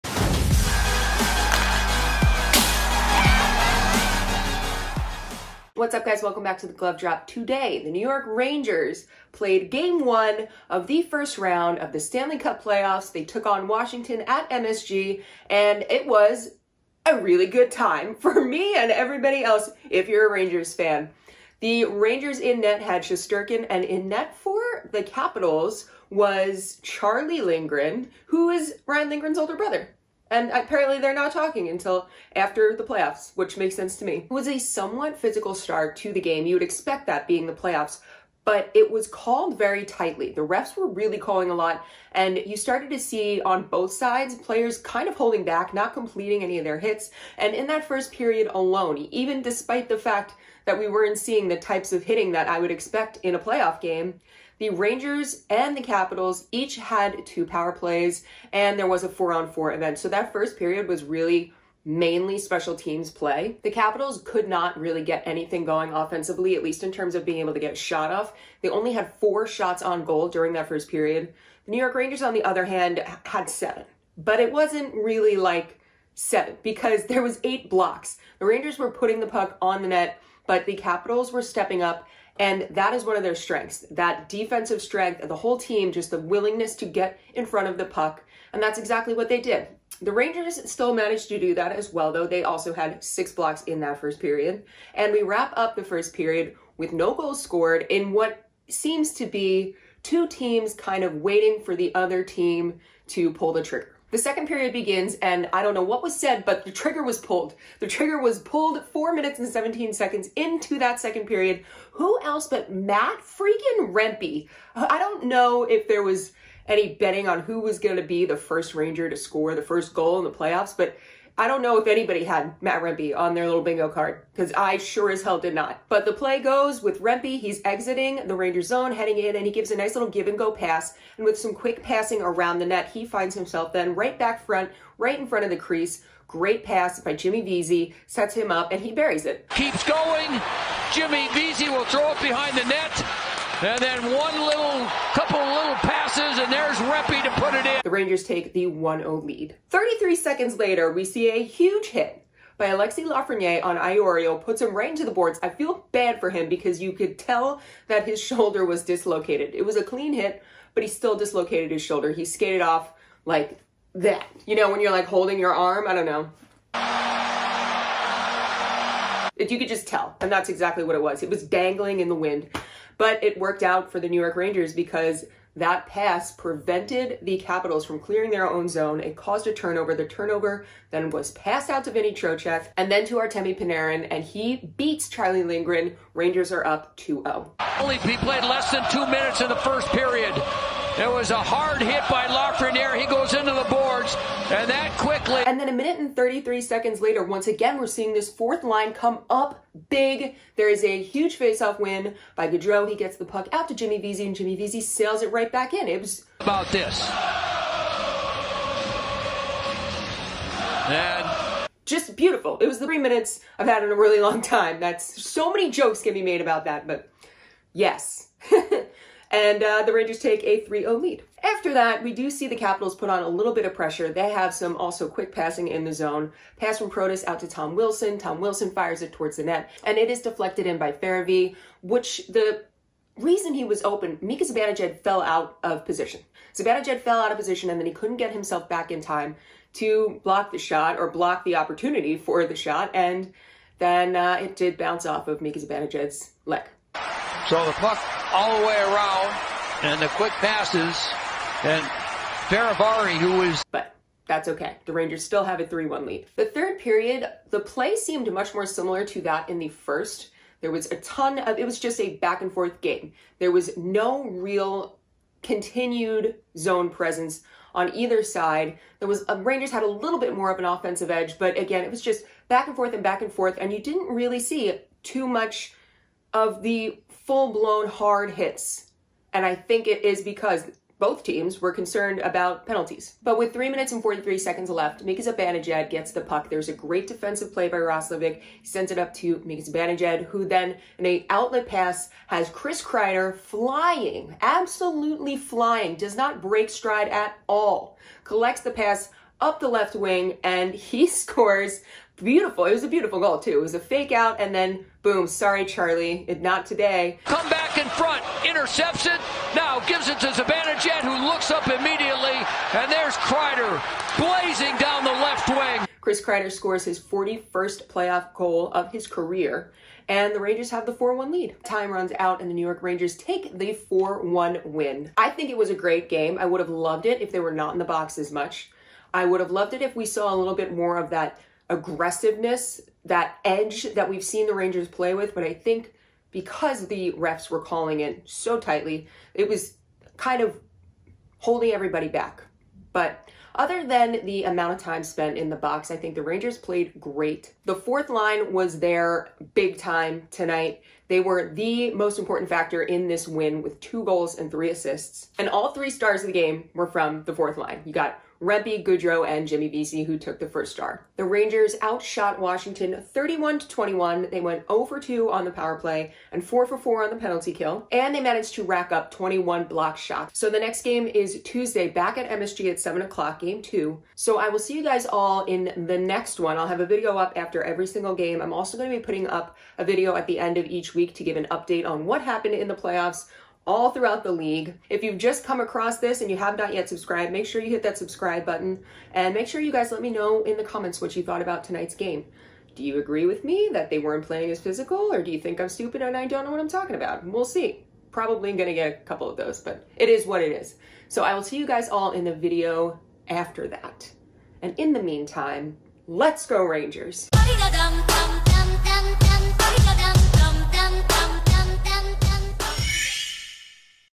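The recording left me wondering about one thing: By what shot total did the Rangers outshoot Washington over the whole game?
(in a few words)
31 to 21.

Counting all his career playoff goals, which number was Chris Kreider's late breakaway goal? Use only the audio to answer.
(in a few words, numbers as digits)
41st.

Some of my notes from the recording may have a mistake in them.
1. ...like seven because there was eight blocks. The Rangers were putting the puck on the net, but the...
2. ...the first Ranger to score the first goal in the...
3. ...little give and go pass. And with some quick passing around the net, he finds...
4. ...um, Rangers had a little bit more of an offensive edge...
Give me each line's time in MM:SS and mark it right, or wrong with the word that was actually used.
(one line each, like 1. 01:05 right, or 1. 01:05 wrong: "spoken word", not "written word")
1. 01:15 right
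2. 01:58 right
3. 02:09 right
4. 04:29 right.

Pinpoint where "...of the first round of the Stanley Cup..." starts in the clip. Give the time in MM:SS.
00:10.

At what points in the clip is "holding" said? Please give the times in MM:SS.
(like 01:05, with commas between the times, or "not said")
00:45, 02:45, 05:41.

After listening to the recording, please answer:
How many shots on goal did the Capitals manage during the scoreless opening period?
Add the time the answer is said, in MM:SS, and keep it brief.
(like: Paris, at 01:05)
4, at 01:09.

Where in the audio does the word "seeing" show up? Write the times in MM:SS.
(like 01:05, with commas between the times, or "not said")
00:51, 03:17.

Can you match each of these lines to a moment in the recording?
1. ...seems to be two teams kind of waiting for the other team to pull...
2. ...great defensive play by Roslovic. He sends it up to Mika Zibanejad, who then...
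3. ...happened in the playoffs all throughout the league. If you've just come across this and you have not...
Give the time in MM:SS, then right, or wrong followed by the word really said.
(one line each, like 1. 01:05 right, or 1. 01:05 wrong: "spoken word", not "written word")
1. 01:38 right
2. 04:46 right
3. 06:22 right.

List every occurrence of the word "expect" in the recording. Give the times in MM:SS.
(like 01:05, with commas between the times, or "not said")
00:36, 00:52.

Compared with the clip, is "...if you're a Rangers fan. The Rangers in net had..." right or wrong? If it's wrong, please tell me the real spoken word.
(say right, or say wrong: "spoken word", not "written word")
right.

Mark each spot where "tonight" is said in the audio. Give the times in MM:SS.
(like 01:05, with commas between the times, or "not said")
05:50, 06:31.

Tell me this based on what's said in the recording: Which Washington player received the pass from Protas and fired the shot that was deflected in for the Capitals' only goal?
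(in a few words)
Tom Wilson.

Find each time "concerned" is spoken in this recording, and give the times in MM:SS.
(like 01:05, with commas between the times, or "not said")
04:41.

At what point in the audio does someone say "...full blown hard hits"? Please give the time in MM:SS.
04:37.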